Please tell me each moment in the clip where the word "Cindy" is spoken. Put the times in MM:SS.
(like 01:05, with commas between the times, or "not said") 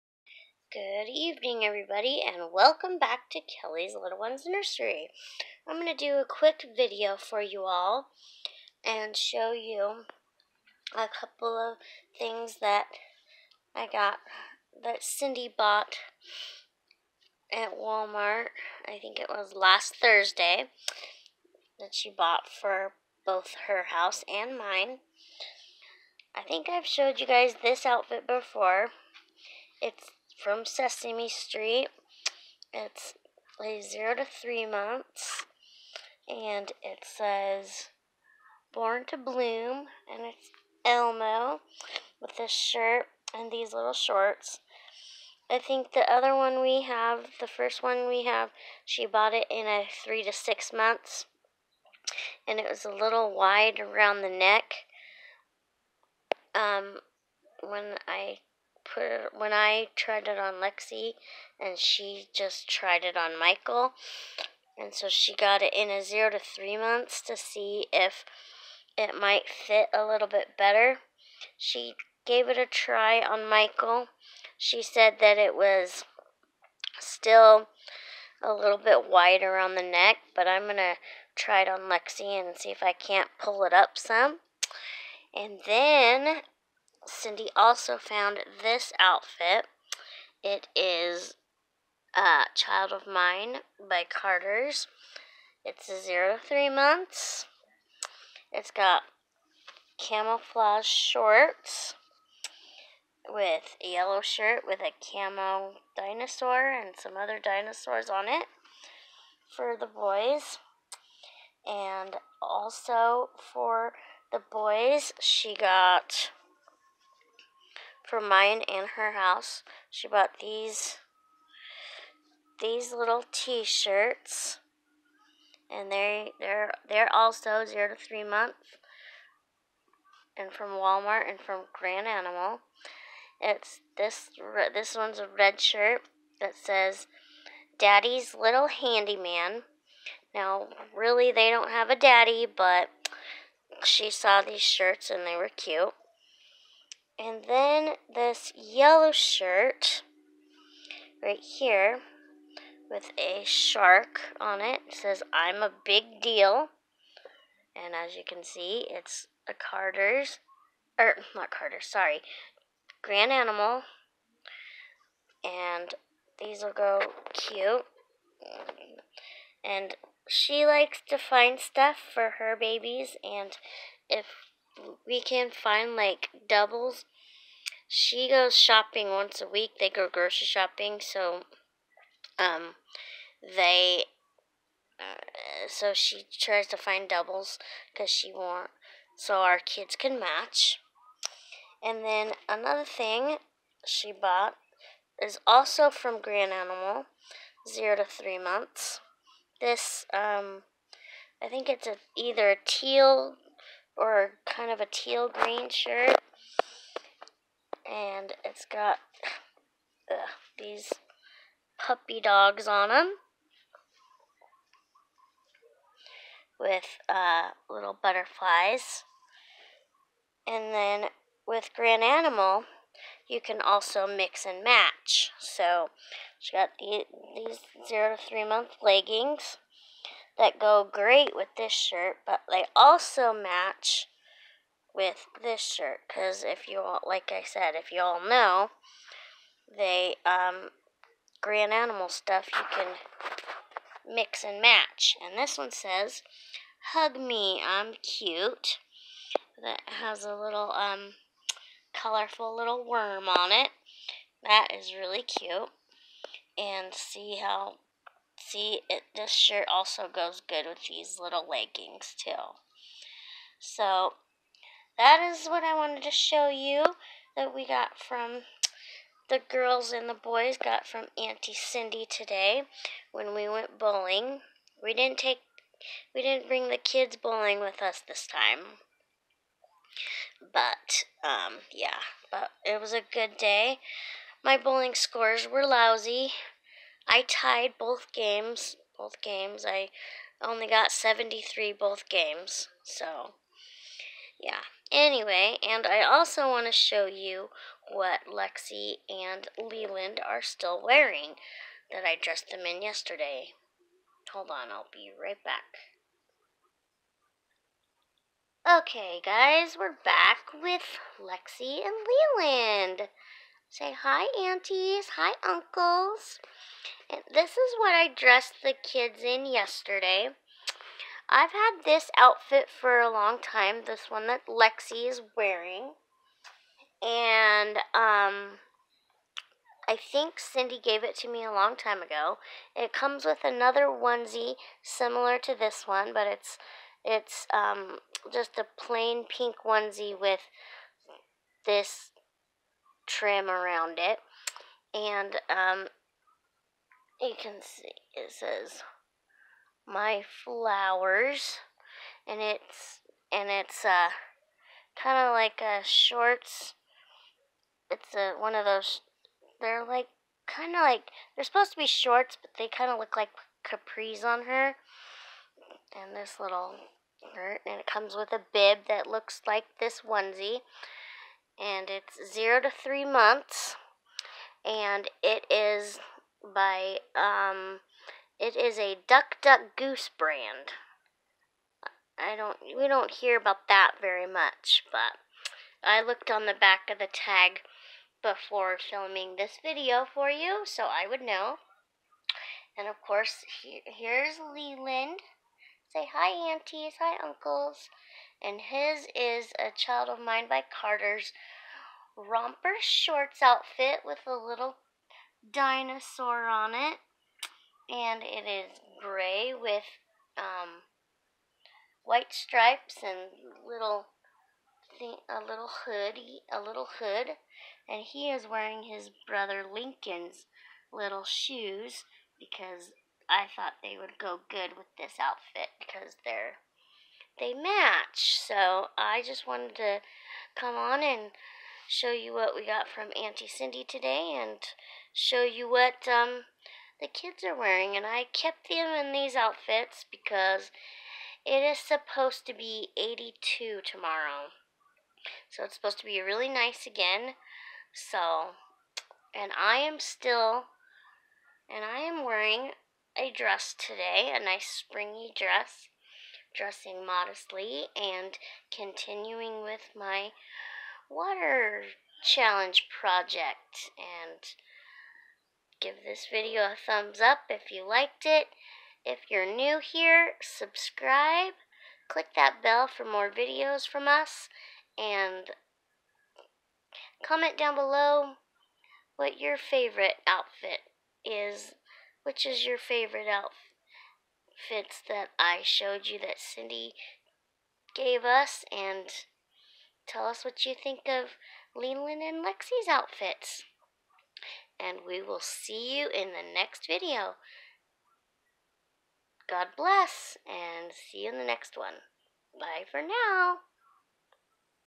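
00:15, 01:27, 04:31, 05:30, 07:13, 08:06.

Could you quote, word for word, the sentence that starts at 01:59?
She bought these these little T-shirts, and they they're they're also zero to three months, and from Walmart and from Garanimal.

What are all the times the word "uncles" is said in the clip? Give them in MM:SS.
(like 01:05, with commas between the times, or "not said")
05:15, 06:37.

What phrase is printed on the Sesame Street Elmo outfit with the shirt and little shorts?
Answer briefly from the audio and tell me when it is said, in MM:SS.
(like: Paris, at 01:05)
Born to Bloom, at 00:38.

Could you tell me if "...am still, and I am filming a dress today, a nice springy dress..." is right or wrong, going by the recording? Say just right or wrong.
wrong.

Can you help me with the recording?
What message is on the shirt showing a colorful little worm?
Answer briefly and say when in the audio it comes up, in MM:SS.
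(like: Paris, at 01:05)
Hug me, I'm cute, at 04:06.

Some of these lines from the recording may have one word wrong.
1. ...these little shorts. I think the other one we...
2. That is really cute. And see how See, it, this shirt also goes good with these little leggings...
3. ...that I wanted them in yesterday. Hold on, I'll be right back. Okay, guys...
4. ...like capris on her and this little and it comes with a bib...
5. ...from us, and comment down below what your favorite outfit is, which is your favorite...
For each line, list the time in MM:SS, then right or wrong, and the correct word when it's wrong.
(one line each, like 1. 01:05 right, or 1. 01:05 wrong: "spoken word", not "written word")
1. 00:43 right
2. 04:14 right
3. 05:01 wrong: "dressed", not "wanted"
4. 06:03 right
5. 07:53 right.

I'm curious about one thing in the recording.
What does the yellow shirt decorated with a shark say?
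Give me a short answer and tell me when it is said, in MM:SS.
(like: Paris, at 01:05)
I'm a big deal, at 02:35.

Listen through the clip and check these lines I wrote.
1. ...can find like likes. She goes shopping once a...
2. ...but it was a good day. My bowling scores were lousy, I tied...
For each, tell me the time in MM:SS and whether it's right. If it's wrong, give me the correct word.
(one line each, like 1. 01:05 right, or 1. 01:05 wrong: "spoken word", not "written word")
1. 02:55 wrong: "doubles", not "likes"
2. 04:42 right.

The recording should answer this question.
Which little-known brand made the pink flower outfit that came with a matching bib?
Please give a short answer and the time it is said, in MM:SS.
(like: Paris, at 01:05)
Duck Duck Goose, at 06:19.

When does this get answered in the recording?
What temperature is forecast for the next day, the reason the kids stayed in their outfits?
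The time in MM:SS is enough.
07:22.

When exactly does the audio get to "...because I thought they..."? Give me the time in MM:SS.
07:02.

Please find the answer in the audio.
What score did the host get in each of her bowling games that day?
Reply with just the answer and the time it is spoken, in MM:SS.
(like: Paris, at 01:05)
73, at 04:50.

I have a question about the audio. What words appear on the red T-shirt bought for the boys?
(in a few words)
Daddy's Little Handyman.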